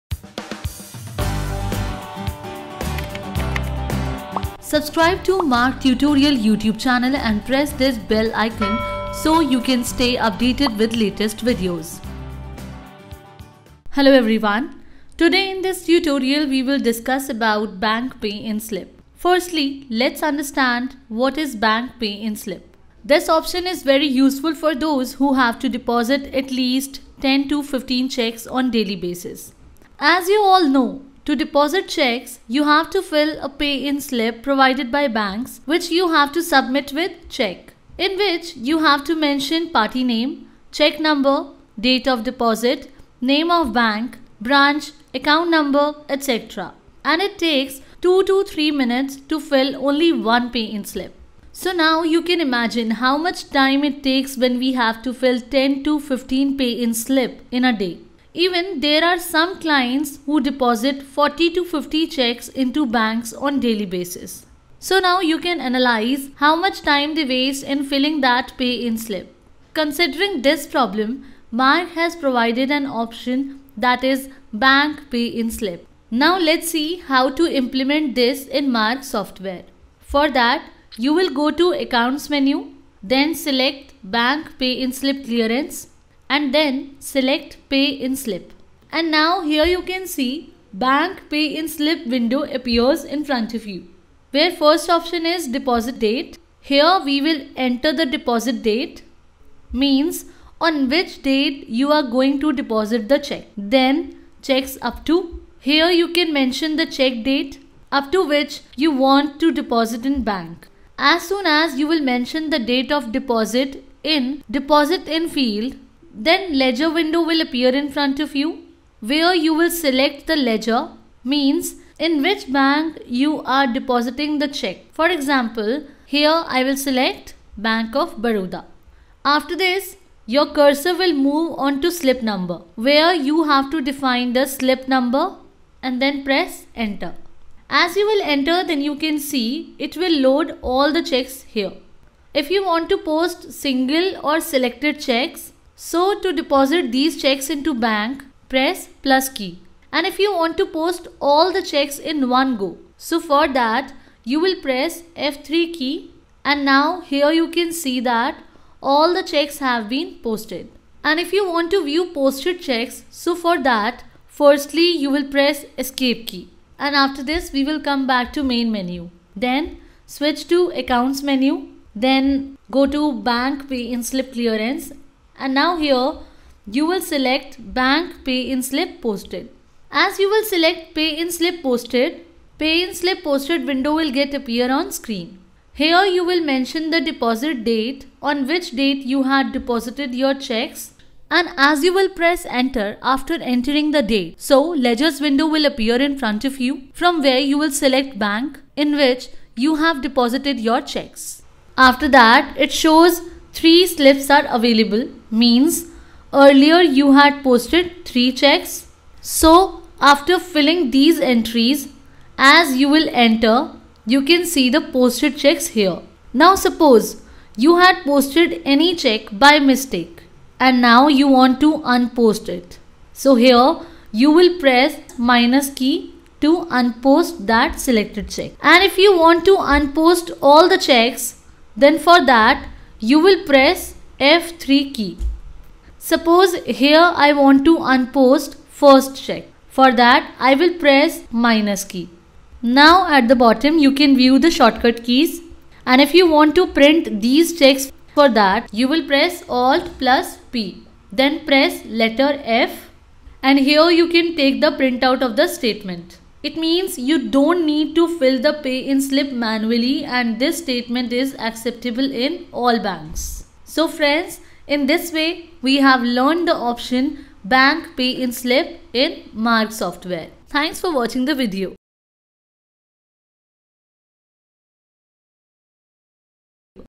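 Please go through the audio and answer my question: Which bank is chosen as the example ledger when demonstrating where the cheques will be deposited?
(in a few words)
Bank of Baroda.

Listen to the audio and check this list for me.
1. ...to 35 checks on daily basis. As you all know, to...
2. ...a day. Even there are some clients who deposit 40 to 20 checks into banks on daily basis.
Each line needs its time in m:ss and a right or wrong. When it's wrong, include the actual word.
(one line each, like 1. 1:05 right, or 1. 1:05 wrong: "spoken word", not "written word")
1. 0:27 wrong: "15", not "35"
2. 0:57 wrong: "50", not "20".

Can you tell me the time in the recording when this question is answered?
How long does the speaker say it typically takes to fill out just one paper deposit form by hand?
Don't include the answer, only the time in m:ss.
0:48.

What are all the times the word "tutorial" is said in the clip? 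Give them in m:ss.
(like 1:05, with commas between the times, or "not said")
0:05, 0:15.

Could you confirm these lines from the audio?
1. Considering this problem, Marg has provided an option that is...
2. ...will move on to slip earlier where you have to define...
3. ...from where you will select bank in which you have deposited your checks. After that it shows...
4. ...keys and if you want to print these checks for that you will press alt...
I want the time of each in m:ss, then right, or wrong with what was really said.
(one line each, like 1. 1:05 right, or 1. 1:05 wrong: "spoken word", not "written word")
1. 1:09 right
2. 2:10 wrong: "number", not "earlier"
3. 3:16 right
4. 4:05 right.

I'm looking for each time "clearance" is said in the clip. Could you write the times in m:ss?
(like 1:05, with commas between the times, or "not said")
1:25, 2:54.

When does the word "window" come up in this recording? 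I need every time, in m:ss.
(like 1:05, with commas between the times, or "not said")
1:32, 1:56, 3:03, 3:15.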